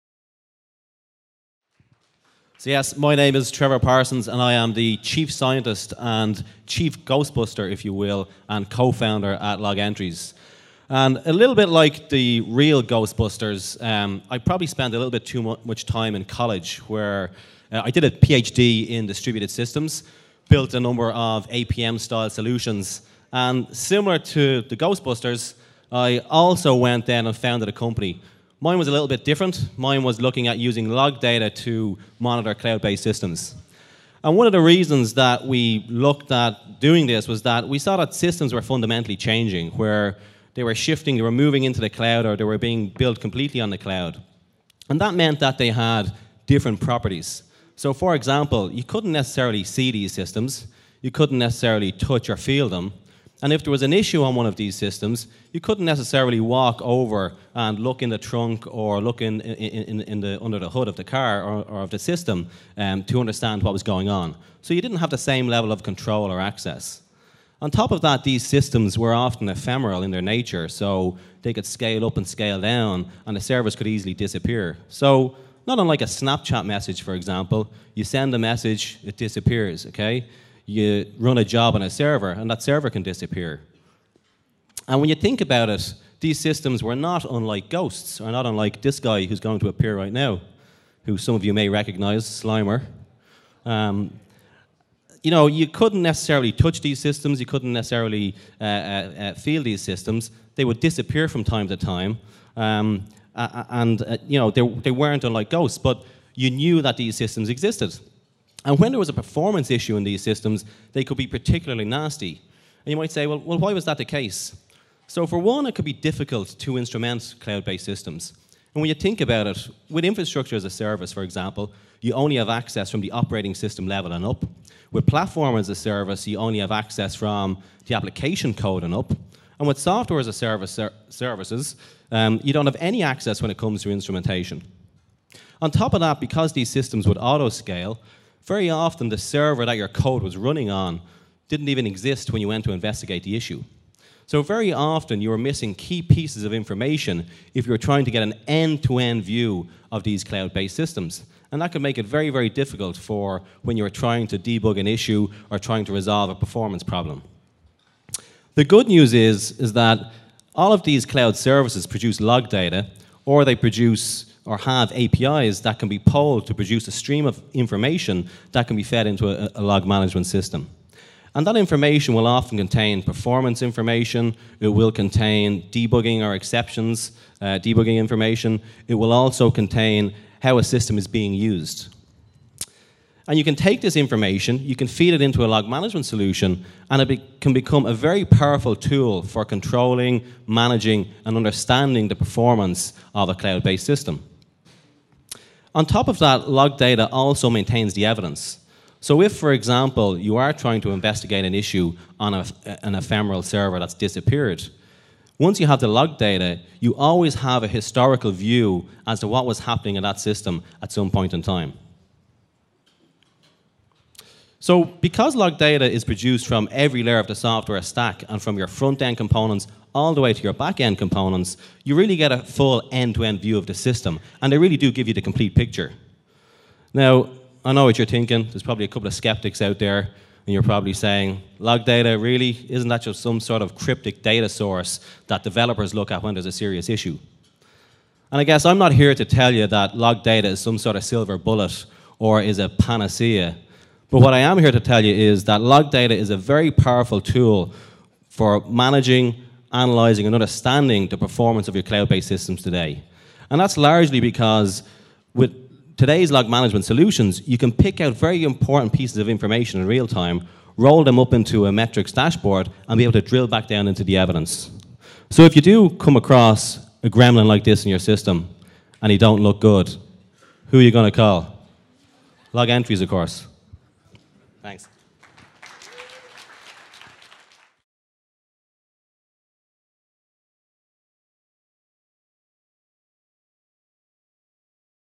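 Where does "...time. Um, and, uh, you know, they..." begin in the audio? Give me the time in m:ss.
1:41.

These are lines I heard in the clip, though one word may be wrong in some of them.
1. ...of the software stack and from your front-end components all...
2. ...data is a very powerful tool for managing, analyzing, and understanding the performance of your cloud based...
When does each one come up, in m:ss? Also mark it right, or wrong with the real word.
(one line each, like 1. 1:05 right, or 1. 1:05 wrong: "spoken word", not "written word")
1. 3:37 right
2. 4:05 right.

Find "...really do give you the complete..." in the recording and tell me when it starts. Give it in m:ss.
3:44.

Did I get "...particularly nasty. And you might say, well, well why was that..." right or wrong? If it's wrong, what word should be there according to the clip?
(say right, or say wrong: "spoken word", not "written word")
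right.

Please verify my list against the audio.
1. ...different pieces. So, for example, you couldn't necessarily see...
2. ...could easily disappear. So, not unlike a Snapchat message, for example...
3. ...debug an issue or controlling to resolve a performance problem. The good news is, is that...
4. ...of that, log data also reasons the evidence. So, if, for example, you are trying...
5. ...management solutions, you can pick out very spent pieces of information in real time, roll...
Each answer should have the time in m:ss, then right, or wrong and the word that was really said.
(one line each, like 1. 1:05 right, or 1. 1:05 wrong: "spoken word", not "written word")
1. 0:46 wrong: "properties", not "pieces"
2. 1:13 right
3. 2:34 wrong: "trying", not "controlling"
4. 3:16 wrong: "maintains", not "reasons"
5. 4:16 wrong: "important", not "spent".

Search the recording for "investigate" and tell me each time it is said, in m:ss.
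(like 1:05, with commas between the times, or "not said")
2:22, 3:20.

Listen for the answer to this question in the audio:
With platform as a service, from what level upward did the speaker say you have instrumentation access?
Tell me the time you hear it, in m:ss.
2:07.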